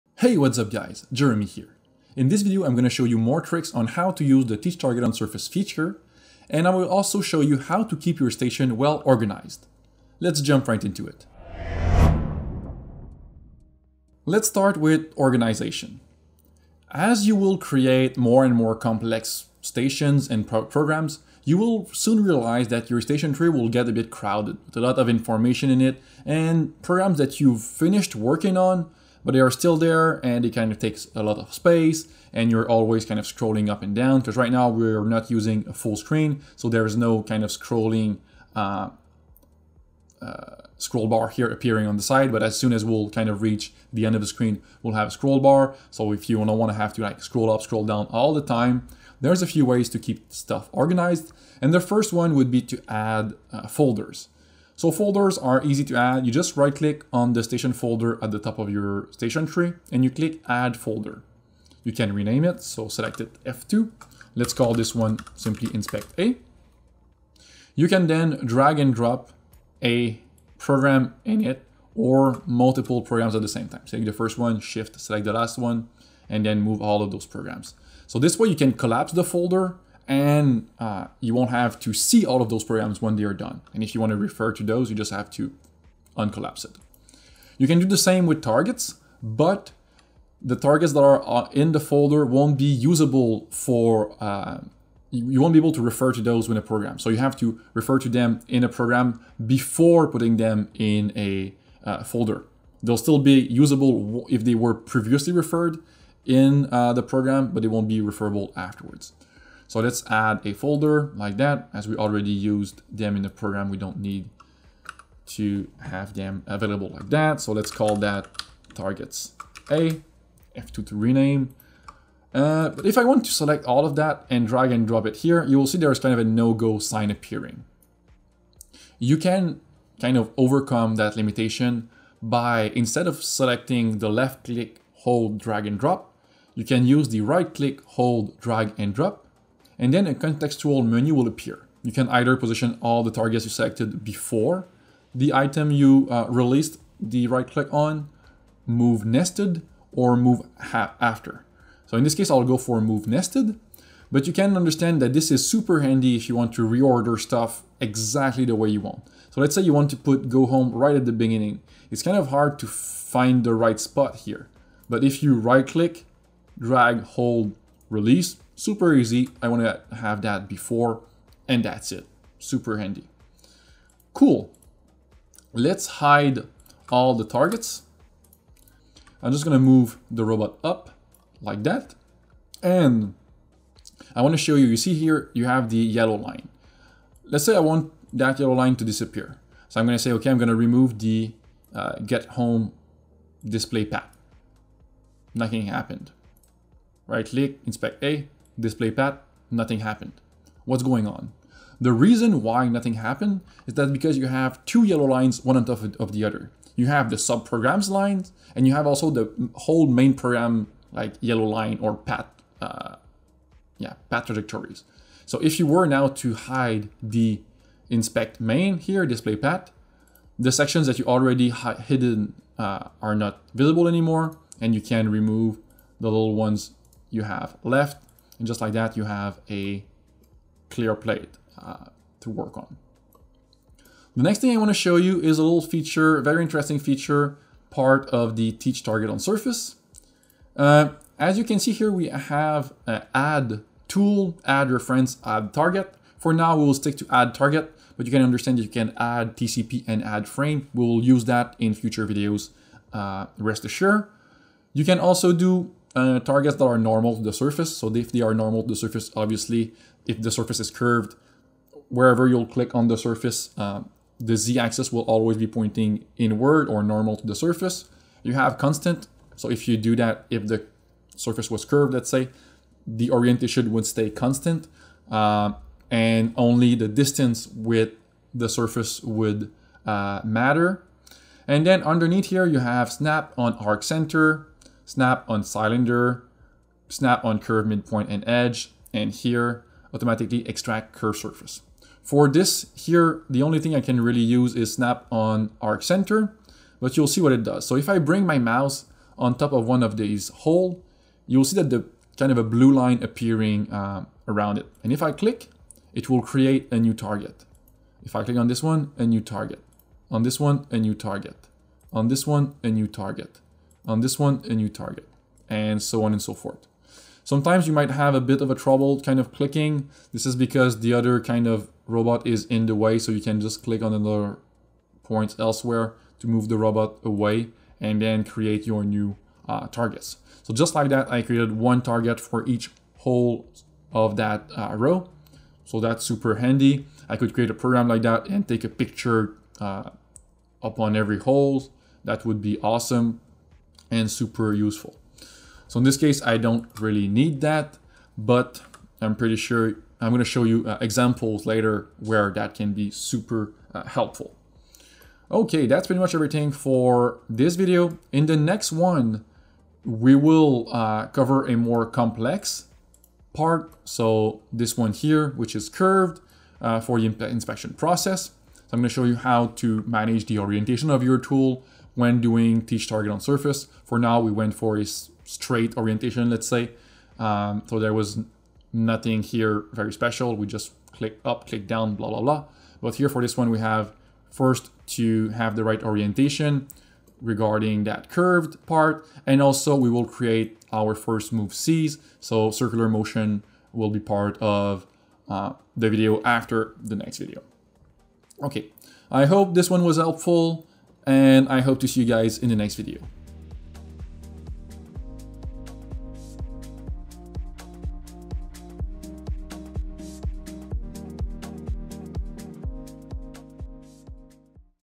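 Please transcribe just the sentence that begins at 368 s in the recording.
So I'm gonna show you how to manage the orientation of your tool, when doing teach target on surface.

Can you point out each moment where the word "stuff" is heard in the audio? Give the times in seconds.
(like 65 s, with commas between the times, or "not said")
50 s, 157 s.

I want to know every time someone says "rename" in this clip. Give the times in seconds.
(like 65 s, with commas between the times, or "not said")
62 s, 120 s.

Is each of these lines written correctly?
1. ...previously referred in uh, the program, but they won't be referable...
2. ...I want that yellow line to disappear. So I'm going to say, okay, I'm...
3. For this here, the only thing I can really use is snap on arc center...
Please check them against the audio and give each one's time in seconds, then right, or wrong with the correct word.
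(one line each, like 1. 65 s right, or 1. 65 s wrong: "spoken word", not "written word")
1. 104 s right
2. 187 s right
3. 292 s right.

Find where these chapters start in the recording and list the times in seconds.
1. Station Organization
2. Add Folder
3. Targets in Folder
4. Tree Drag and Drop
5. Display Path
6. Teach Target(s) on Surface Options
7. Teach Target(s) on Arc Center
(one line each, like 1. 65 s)
1. 14 s
2. 55 s
3. 85 s
4. 125 s
5. 185 s
6. 240 s
7. 295 s.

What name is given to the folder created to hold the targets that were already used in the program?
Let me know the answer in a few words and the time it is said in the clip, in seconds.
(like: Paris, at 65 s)
targets A, at 118 s.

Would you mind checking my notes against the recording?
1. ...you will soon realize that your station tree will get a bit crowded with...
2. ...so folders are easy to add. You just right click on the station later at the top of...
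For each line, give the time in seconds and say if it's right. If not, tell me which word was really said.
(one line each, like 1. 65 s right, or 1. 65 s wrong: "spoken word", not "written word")
1. 21 s right
2. 54 s wrong: "folder", not "later".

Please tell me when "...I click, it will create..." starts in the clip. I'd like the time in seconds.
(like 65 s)
305 s.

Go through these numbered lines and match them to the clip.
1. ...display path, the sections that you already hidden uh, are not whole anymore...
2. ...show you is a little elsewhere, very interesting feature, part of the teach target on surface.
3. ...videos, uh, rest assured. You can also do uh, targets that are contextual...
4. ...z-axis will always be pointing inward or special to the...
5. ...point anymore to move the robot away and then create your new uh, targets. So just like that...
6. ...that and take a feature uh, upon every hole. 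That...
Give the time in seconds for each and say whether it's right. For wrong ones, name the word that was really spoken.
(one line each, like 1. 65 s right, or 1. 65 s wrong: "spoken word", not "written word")
1. 219 s wrong: "visible", not "whole"
2. 234 s wrong: "feature", not "elsewhere"
3. 252 s wrong: "normal", not "contextual"
4. 264 s wrong: "normal", not "special"
5. 325 s wrong: "elsewhere", not "anymore"
6. 338 s wrong: "picture", not "feature".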